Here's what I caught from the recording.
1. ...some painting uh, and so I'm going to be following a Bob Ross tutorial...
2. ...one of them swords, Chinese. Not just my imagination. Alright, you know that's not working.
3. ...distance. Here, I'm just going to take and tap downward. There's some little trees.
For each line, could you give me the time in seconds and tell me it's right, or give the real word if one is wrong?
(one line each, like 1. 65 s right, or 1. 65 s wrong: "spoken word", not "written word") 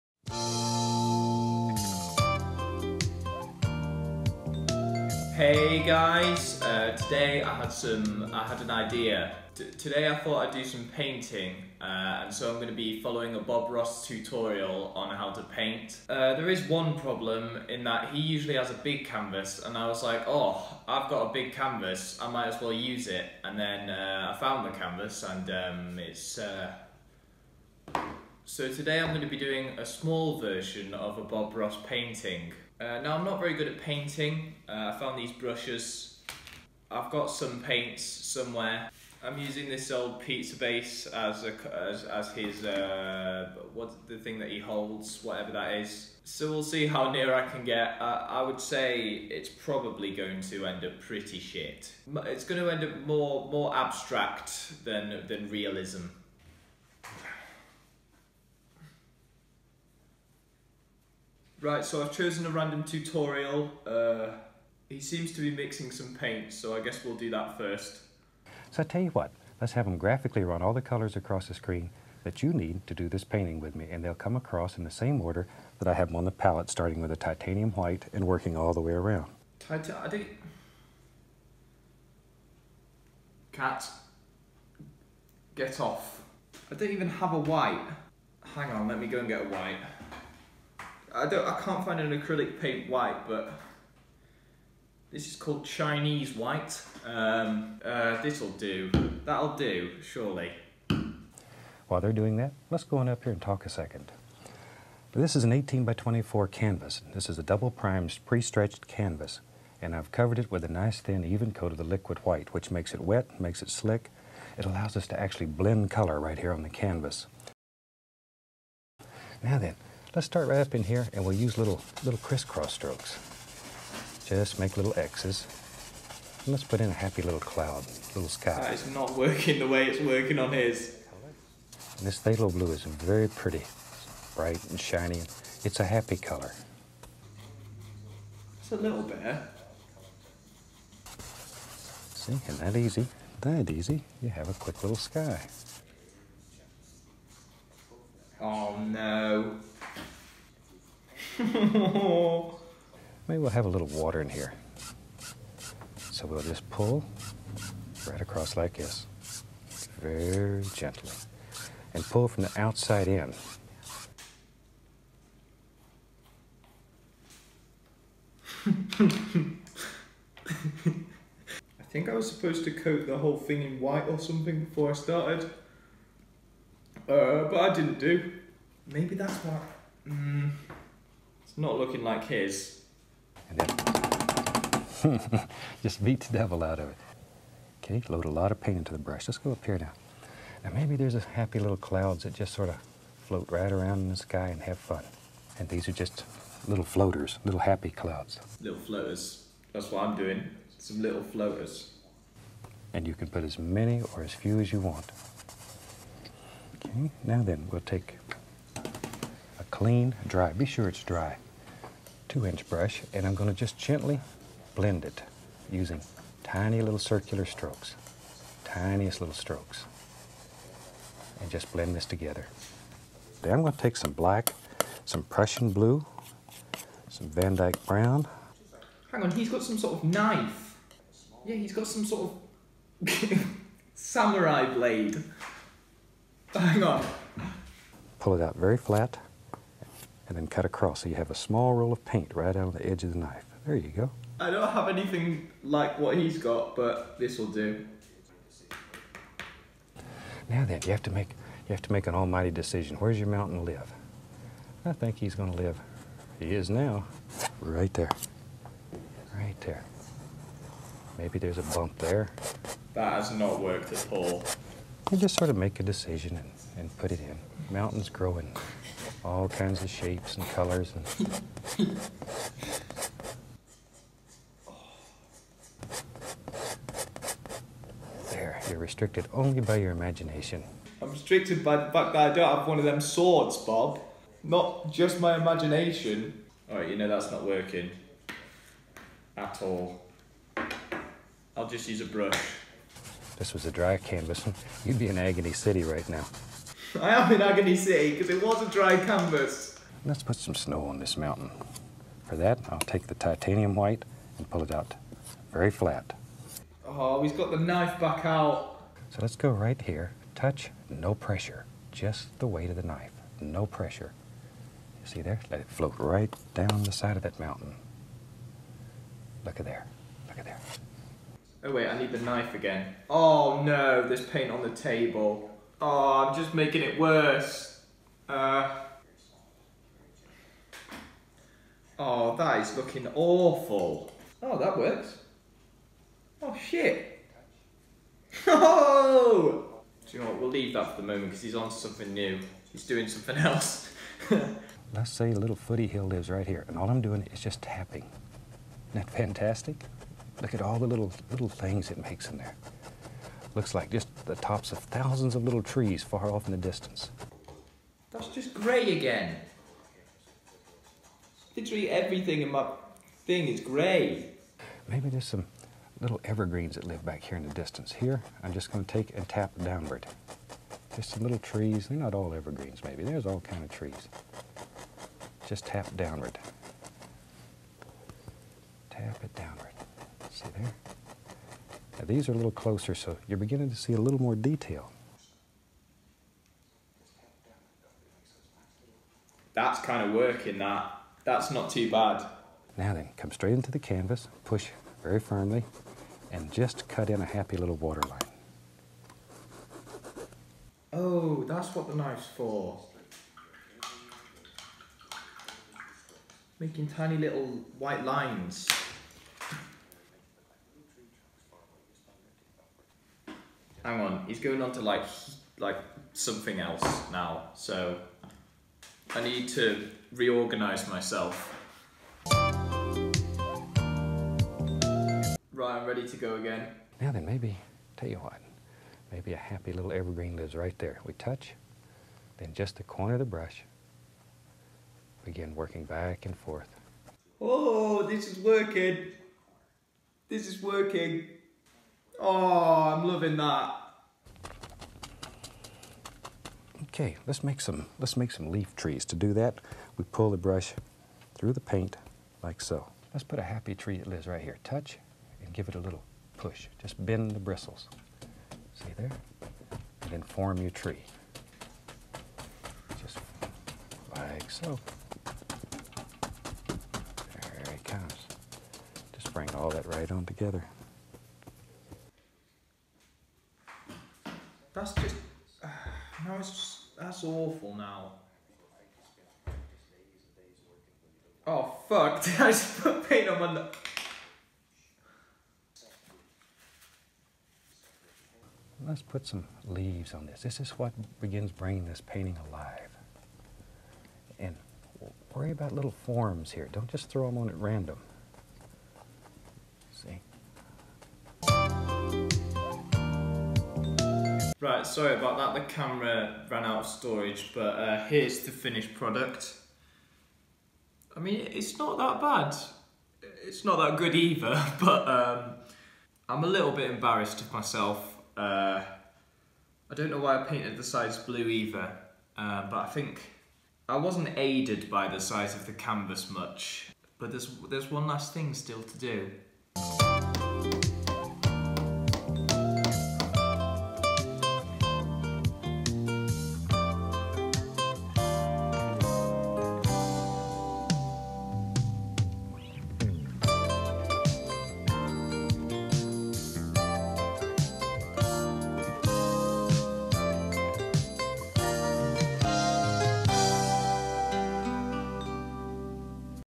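1. 10 s right
2. 282 s wrong: "Bob", not "Chinese"
3. 367 s right.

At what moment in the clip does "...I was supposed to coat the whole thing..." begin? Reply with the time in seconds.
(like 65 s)
172 s.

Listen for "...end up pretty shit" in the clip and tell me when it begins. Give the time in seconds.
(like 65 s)
50 s.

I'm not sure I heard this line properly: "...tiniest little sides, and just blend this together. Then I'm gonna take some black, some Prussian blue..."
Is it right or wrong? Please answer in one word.
wrong.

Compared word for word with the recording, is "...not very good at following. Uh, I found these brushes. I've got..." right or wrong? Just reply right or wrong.
wrong.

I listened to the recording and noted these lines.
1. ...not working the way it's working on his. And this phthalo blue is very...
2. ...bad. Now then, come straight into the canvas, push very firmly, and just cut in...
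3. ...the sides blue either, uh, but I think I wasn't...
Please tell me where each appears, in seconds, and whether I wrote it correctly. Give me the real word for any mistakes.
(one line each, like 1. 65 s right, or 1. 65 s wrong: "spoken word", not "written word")
1. 128 s right
2. 391 s right
3. 520 s right.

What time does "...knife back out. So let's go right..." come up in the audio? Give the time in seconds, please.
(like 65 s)
307 s.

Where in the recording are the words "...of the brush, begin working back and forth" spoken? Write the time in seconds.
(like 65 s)
433 s.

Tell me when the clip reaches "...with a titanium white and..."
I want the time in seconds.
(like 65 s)
76 s.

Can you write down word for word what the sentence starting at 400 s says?
Oh, that's what the knife's for.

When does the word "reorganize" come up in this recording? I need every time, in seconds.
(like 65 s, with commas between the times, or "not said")
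420 s.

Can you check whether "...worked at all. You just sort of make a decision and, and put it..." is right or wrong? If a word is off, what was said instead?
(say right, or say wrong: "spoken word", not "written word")
right.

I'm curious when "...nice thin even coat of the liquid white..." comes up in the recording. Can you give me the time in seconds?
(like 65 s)
110 s.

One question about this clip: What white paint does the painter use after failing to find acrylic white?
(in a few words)
Chinese white.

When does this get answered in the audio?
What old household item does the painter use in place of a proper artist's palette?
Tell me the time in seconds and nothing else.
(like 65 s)
40 s.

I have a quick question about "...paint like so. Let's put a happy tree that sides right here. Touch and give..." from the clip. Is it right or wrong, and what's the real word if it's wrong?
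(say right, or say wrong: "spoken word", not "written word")
wrong: "lives", not "sides".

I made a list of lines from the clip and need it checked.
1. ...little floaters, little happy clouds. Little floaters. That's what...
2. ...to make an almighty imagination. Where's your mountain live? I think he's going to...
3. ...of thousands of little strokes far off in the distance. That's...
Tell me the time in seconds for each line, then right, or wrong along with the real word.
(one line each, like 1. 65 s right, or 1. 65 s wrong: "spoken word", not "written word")
1. 196 s right
2. 251 s wrong: "decision", not "imagination"
3. 354 s wrong: "trees", not "strokes".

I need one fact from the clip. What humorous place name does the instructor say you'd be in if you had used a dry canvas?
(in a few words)
Agony City.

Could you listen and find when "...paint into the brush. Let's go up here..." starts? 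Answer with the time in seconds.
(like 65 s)
188 s.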